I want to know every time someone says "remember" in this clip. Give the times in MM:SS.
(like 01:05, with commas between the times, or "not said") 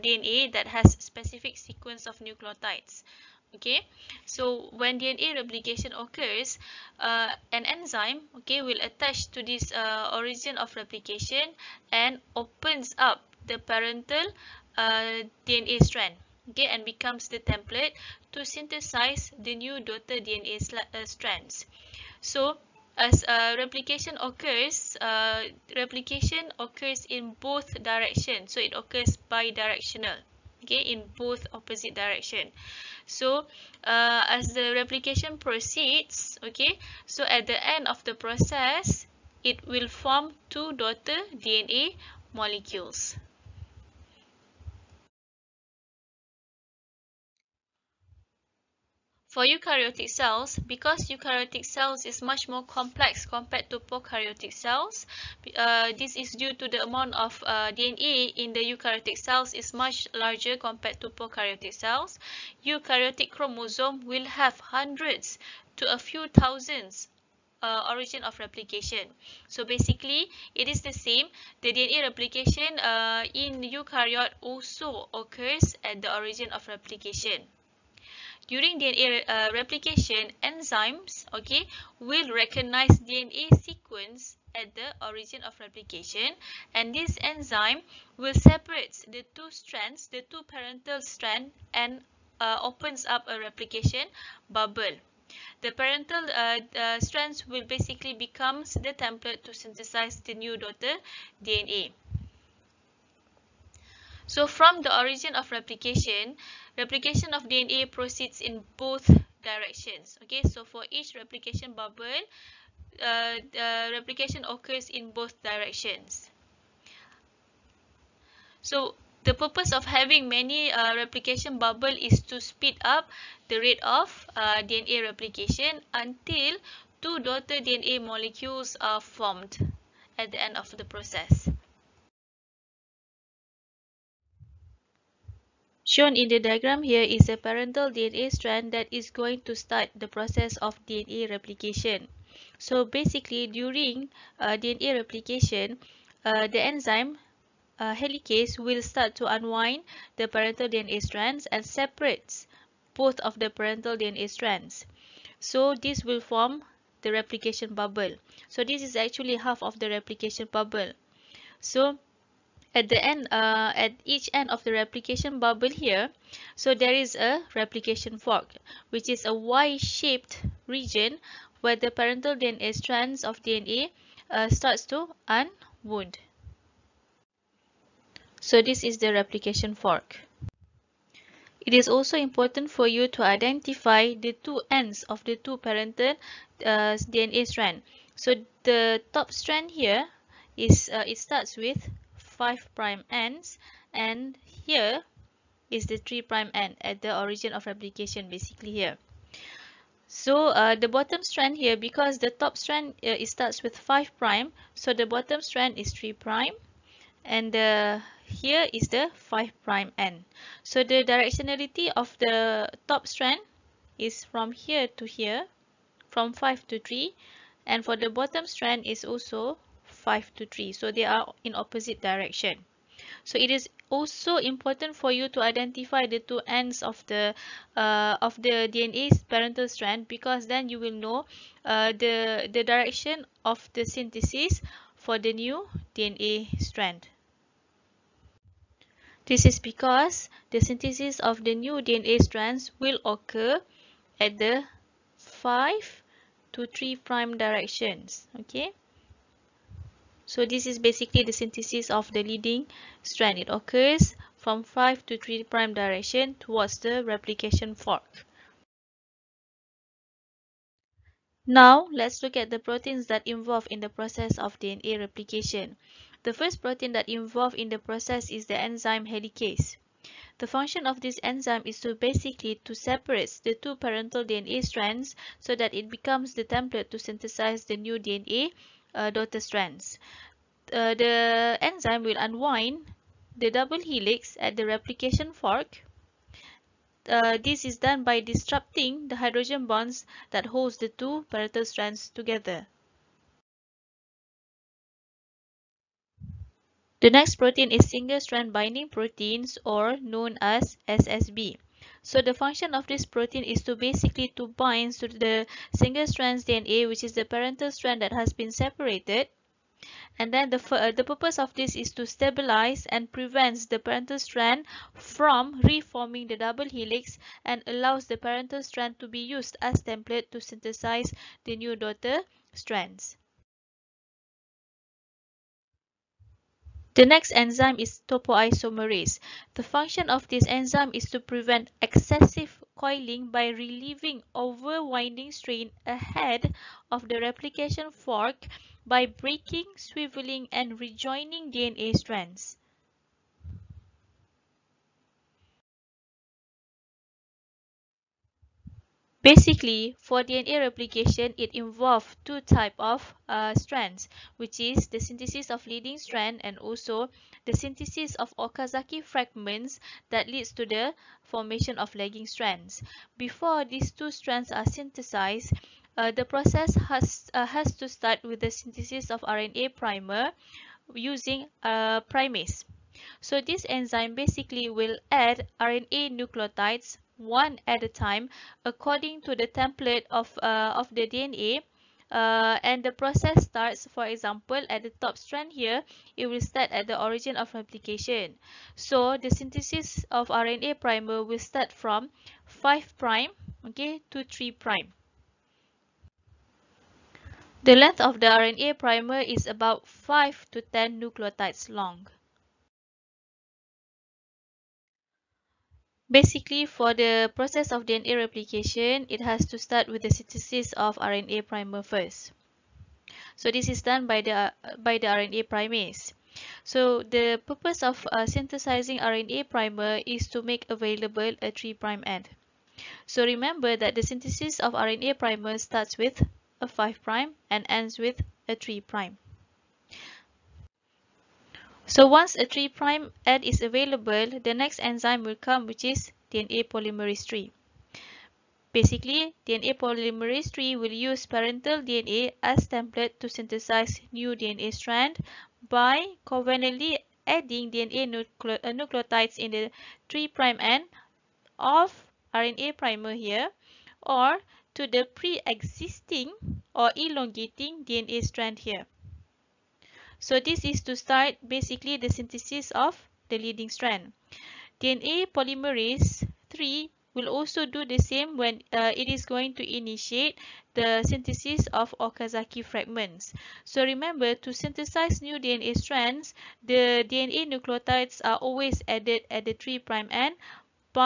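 07:03, 07:53.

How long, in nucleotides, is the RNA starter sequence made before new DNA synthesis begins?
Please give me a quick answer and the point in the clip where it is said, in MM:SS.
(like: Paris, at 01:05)
5 to 10 nucleotides, at 06:39.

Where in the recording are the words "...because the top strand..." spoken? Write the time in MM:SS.
03:21.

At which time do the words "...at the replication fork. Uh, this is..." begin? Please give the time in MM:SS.
04:44.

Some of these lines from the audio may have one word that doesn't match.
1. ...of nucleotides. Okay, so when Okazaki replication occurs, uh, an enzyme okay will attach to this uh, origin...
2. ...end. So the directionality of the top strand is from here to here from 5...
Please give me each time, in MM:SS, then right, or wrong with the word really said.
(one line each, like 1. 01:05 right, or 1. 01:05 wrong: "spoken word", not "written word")
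1. 00:02 wrong: "DNA", not "Okazaki"
2. 03:29 right.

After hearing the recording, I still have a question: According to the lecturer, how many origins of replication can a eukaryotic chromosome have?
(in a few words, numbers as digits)
Hundreds to a few thousands.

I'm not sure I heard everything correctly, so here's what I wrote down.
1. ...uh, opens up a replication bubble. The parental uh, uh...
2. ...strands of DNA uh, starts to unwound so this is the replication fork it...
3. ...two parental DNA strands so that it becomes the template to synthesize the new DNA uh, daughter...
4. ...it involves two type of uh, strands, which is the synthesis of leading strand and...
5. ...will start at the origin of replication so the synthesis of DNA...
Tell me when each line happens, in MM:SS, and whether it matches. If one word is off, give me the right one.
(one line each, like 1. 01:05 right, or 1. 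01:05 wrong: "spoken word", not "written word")
1. 01:32 right
2. 02:52 right
3. 04:33 right
4. 05:51 right
5. 06:26 wrong: "RNA", not "DNA".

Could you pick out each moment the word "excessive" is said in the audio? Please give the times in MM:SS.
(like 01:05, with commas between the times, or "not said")
05:31.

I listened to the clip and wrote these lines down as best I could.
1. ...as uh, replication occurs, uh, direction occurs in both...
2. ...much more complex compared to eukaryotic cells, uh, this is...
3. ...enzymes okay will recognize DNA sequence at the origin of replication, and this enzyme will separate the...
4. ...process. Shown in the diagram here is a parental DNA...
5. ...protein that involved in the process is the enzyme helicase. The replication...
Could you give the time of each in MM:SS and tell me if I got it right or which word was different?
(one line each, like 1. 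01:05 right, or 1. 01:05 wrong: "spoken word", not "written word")
1. 00:22 wrong: "replication", not "direction"
2. 00:52 wrong: "prokaryotic", not "eukaryotic"
3. 01:20 right
4. 02:10 right
5. 04:26 wrong: "function", not "replication".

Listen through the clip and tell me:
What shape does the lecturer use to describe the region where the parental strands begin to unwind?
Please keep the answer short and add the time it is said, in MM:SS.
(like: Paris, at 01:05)
Y-shaped, at 02:49.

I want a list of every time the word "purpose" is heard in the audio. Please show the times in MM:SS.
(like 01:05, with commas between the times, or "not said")
01:59, 05:11, 06:57.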